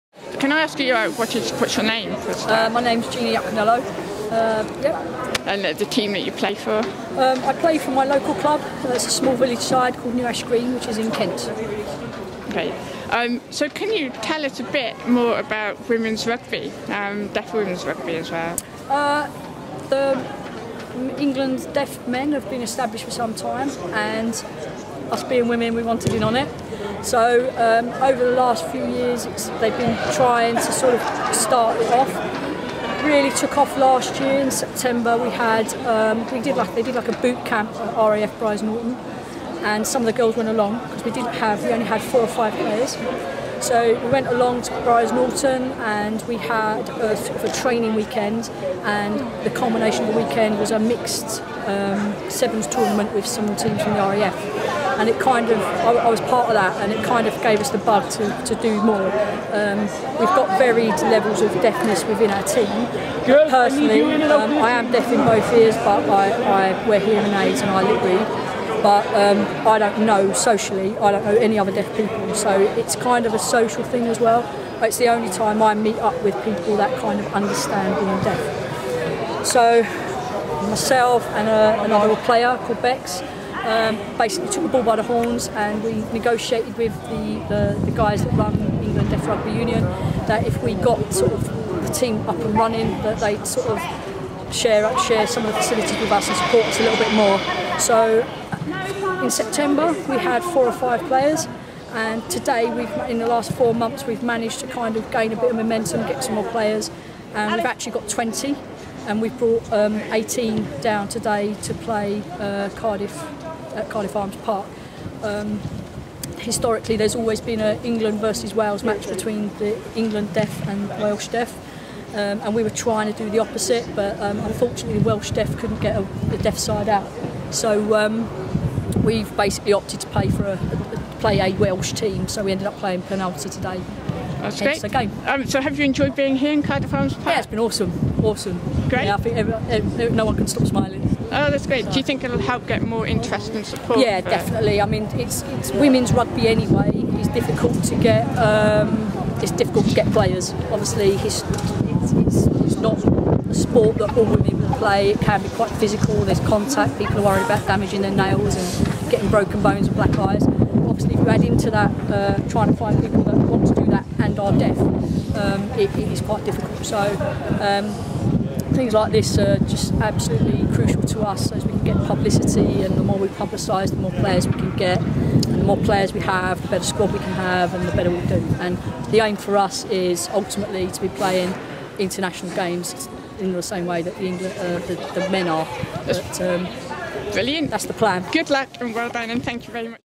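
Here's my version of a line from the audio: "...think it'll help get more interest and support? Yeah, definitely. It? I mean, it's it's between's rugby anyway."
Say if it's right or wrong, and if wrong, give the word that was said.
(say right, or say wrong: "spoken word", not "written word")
wrong: "women", not "between".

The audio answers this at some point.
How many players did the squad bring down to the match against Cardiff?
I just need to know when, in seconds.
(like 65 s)
110 s.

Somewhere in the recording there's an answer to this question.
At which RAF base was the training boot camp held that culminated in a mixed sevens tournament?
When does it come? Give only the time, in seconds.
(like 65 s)
37 s.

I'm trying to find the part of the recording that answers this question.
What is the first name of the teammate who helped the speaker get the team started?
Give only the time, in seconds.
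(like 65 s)
82 s.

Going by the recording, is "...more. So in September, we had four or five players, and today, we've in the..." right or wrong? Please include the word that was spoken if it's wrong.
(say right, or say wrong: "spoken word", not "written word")
right.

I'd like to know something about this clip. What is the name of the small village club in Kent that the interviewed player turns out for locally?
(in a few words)
New Ash Green.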